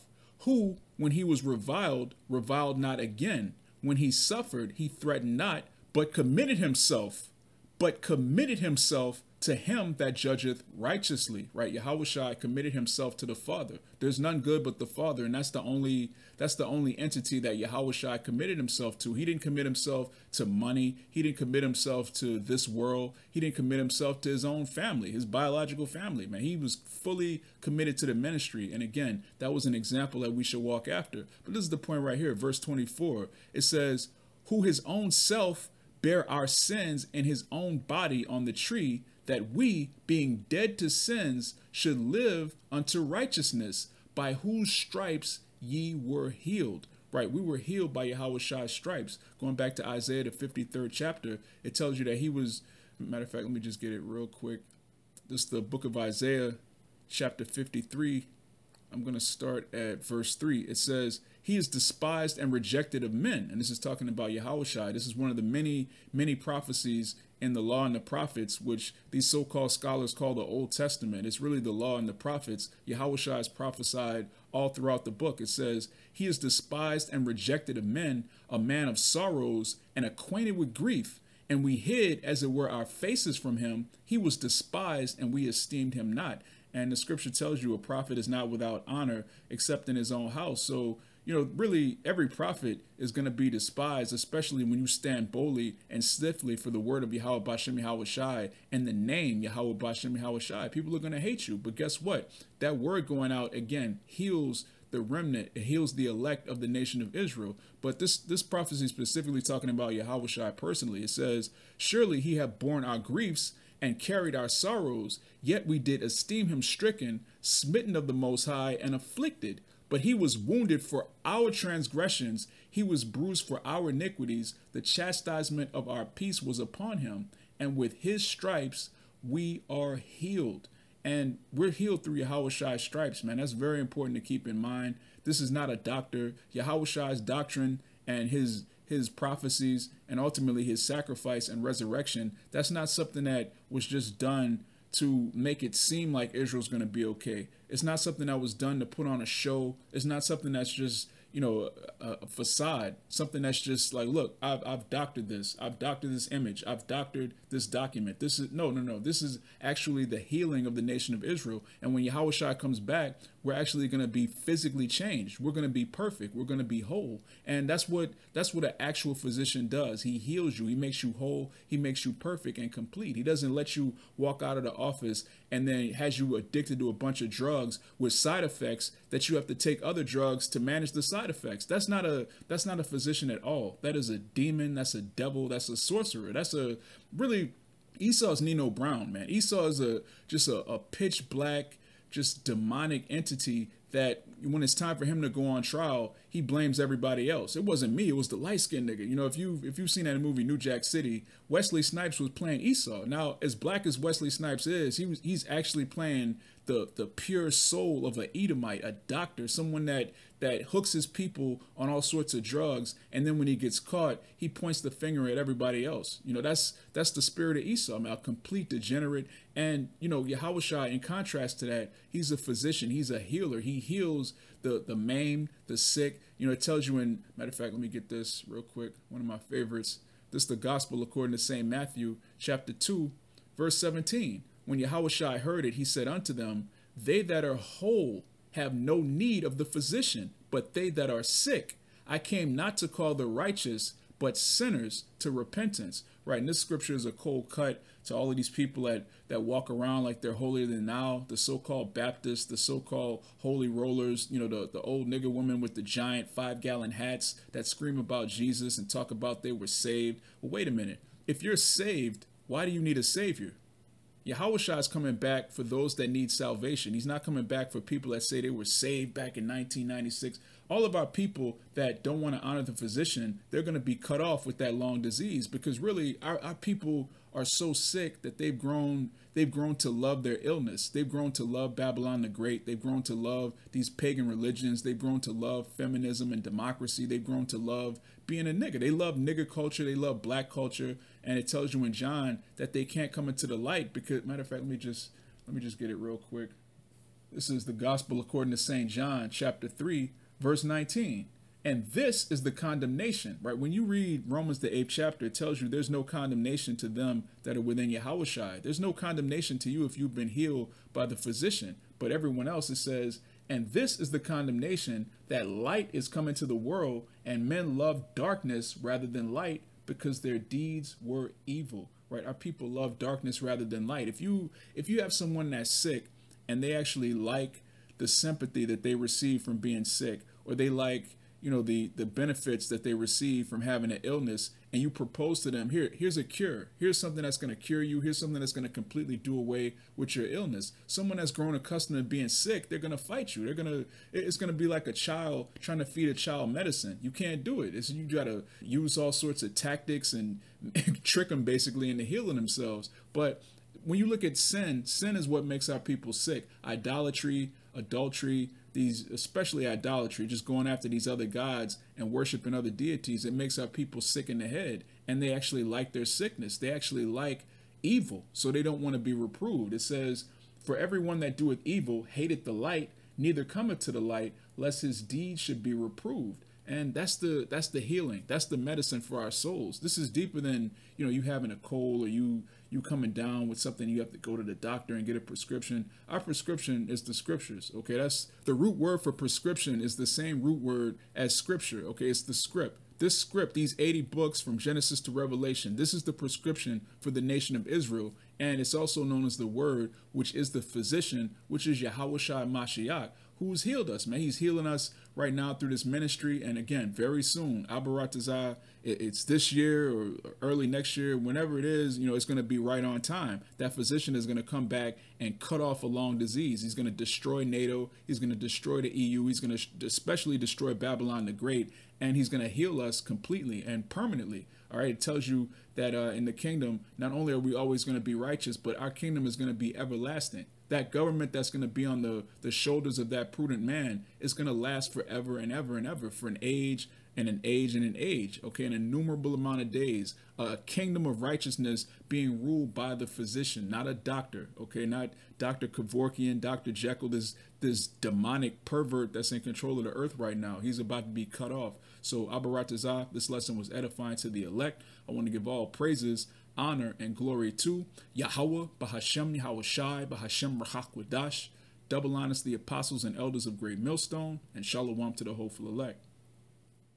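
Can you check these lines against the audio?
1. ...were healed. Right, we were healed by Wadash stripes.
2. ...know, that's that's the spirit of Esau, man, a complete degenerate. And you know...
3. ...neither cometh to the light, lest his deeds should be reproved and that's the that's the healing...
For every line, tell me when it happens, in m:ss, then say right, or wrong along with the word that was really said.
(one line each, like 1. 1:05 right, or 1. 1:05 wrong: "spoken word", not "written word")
1. 0:45 wrong: "Yahweh", not "Wadash"
2. 3:36 right
3. 6:13 right.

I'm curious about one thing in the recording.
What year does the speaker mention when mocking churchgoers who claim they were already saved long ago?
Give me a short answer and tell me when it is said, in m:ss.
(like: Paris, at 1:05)
1996, at 4:29.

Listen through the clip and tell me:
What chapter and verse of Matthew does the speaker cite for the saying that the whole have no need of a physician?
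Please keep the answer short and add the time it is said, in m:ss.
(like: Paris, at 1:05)
chapter 2, verse 17, at 3:52.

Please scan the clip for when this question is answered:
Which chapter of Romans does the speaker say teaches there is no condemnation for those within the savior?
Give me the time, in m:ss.
5:04.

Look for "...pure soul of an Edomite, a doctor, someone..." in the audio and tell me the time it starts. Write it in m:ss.
3:27.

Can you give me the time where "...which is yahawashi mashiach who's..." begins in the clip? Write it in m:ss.
6:41.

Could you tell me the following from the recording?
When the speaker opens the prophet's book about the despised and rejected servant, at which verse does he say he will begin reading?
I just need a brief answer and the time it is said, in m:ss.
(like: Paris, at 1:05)
verse 3, at 1:00.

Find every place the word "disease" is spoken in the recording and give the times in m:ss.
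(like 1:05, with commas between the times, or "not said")
4:34, 6:56.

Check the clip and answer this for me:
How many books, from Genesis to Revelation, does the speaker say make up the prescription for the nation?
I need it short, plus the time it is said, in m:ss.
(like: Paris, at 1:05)
80, at 6:33.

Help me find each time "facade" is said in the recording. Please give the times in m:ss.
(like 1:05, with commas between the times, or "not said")
2:32.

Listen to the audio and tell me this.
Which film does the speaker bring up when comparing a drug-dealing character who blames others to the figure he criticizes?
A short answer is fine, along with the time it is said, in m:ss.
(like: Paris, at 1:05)
New Jack City, at 3:20.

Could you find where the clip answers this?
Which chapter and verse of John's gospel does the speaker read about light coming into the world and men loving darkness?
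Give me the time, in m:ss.
4:59.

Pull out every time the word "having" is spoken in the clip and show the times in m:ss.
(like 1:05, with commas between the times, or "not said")
5:33, 6:21.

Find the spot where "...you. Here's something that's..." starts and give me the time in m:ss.
5:37.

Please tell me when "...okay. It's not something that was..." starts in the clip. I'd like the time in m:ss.
2:27.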